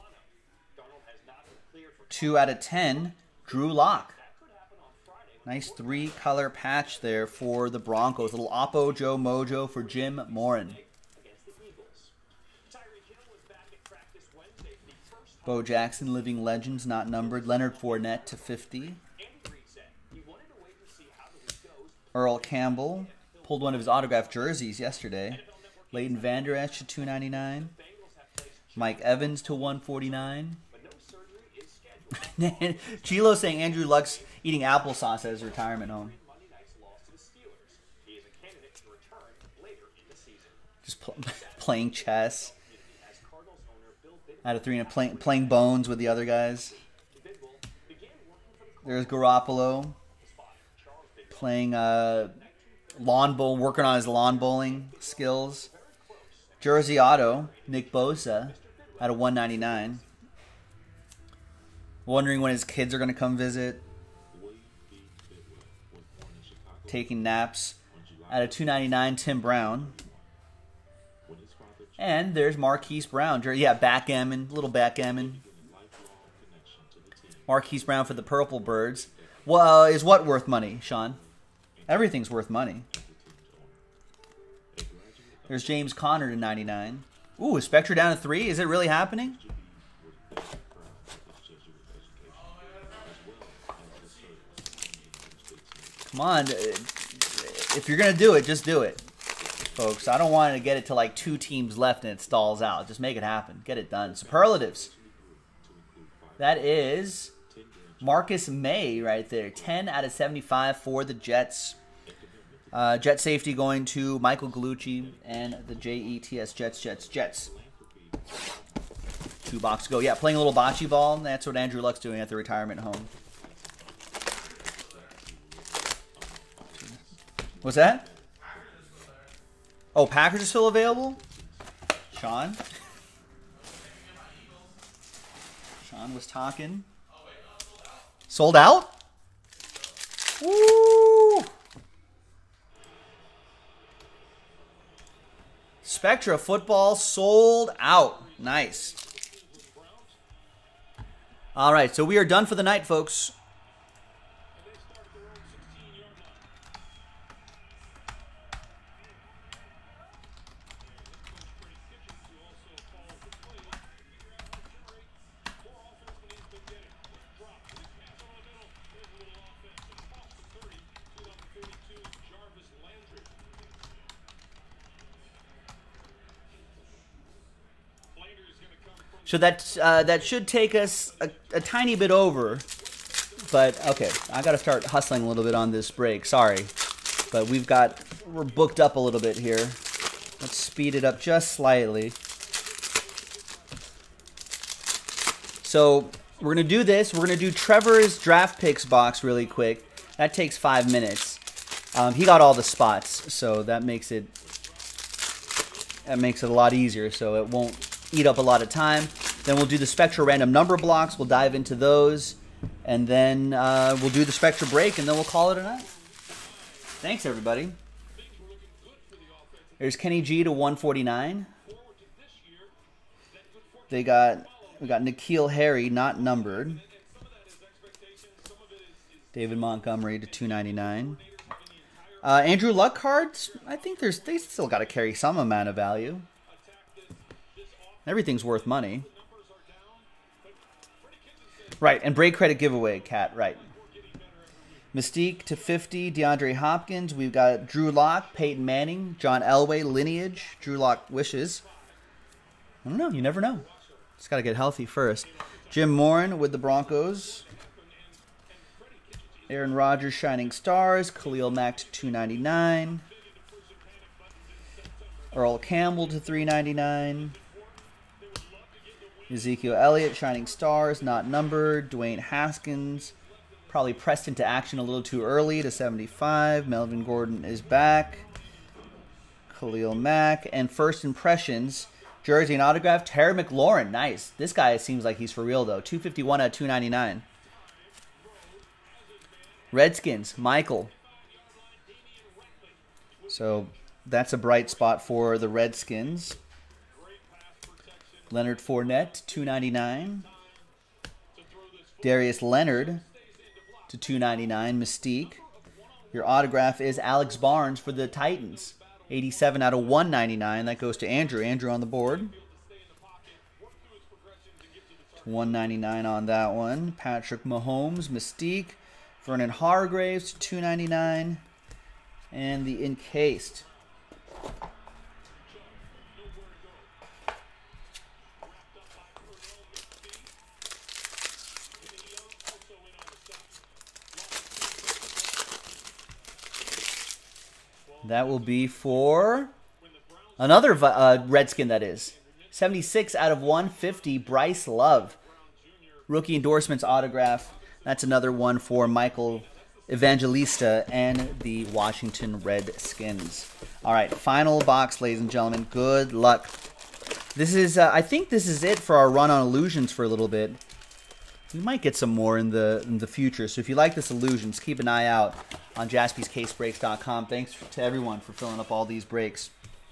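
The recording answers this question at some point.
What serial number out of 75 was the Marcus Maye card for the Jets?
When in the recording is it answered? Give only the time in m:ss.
1:49.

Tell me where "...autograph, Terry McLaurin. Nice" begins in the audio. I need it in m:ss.
4:42.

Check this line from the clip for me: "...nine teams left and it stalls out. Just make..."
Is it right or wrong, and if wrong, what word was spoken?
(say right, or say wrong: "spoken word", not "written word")
wrong: "two", not "nine".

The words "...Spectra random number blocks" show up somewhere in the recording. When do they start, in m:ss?
3:29.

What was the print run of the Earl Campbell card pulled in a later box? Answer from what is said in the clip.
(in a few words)
399.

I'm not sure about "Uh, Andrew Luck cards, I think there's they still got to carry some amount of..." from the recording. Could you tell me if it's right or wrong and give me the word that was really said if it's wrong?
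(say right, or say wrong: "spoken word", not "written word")
right.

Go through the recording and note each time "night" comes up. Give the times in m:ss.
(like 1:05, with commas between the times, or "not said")
2:32, 3:35.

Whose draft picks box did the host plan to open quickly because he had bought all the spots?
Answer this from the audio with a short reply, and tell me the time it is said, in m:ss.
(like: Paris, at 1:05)
Trevor, at 3:17.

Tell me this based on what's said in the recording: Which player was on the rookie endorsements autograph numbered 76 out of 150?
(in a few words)
Bryce Love.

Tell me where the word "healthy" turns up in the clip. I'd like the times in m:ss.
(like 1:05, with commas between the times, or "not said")
4:14.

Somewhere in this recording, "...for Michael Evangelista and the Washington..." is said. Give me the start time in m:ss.
5:48.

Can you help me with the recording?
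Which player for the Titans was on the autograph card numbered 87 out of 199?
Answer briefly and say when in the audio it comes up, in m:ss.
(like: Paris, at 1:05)
Alex Barnes, at 5:06.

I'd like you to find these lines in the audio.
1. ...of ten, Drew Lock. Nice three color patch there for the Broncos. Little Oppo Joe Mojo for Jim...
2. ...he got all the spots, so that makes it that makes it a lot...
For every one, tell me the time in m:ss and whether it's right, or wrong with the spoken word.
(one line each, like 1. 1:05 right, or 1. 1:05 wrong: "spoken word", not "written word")
1. 0:02 right
2. 3:22 right.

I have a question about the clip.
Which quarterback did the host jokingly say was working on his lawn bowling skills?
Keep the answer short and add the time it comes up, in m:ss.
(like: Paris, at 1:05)
Garoppolo, at 0:49.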